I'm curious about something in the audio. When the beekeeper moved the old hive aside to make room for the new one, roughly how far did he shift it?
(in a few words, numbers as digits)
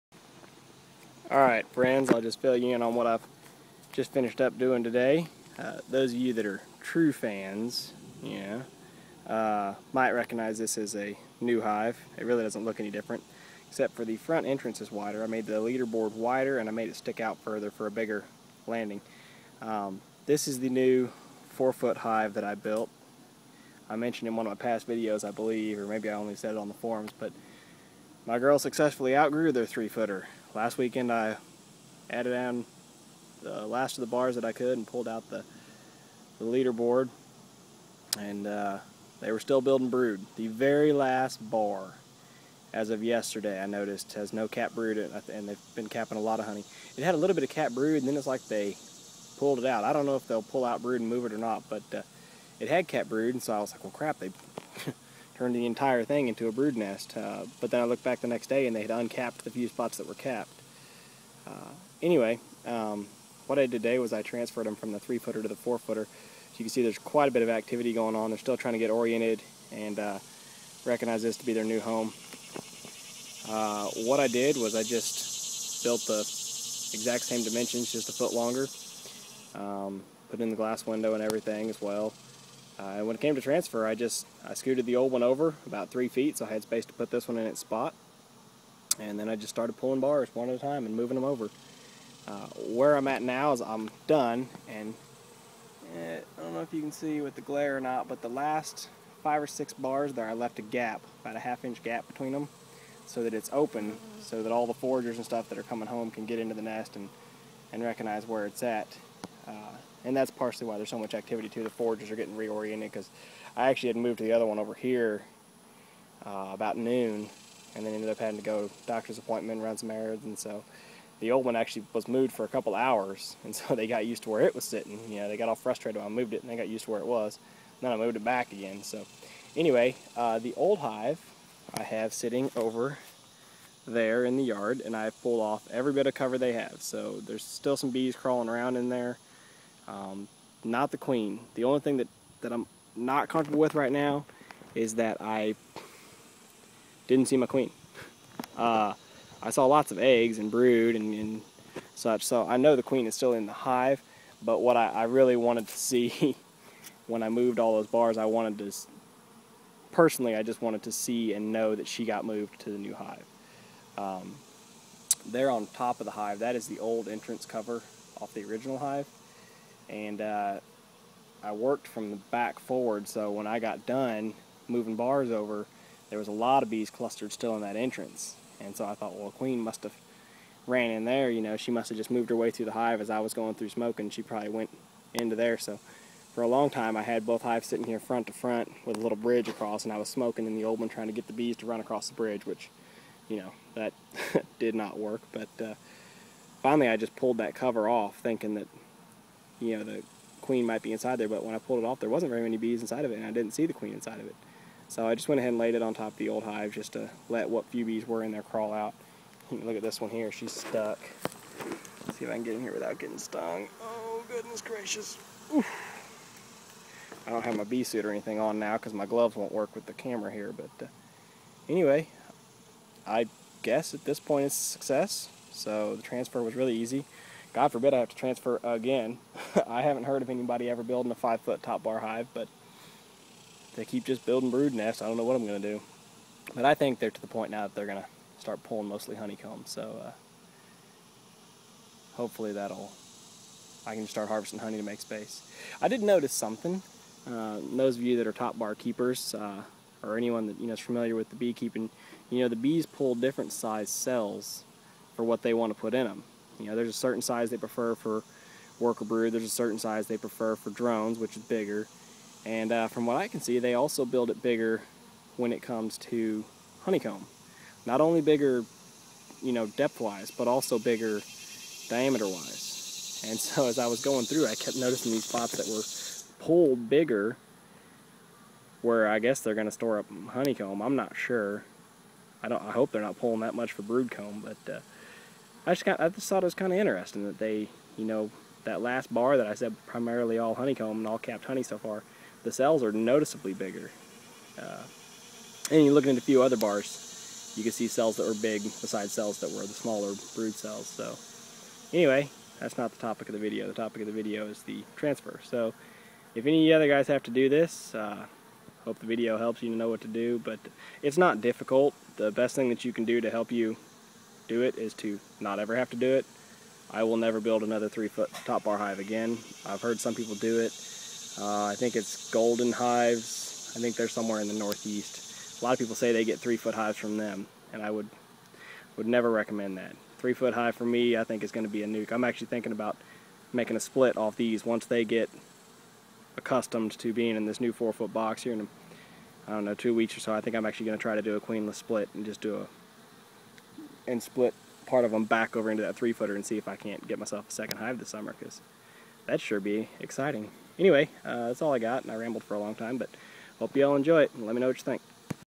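3 feet.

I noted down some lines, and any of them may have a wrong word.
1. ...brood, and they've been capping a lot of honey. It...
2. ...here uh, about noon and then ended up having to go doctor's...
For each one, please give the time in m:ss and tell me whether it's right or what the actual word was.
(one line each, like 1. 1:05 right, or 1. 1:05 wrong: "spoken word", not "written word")
1. 0:44 right
2. 1:54 right.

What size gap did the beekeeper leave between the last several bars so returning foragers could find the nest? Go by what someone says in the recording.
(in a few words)
half inch.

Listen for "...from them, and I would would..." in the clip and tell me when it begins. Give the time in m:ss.
5:26.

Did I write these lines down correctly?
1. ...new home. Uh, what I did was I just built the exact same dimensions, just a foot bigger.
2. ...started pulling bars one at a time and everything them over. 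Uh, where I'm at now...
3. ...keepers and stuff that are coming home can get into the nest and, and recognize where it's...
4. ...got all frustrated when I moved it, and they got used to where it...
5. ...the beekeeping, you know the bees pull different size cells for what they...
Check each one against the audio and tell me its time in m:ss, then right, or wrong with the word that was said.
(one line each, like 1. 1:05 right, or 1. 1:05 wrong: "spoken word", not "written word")
1. 1:11 wrong: "longer", not "bigger"
2. 1:29 wrong: "moving", not "everything"
3. 1:44 wrong: "foragers", not "keepers"
4. 2:05 right
5. 4:11 right.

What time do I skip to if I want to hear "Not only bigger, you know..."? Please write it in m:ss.
4:27.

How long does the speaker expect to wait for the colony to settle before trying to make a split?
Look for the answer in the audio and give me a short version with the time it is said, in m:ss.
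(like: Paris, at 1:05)
2 weeks, at 5:39.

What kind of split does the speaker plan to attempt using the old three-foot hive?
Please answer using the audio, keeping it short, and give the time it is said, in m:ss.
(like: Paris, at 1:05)
queenless split, at 5:41.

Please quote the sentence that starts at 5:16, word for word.
I will never build another three foot top bar hive again.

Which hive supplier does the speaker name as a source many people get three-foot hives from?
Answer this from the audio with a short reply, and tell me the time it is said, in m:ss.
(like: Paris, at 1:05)
Golden Hives, at 5:22.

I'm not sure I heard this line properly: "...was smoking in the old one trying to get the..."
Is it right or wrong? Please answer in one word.
right.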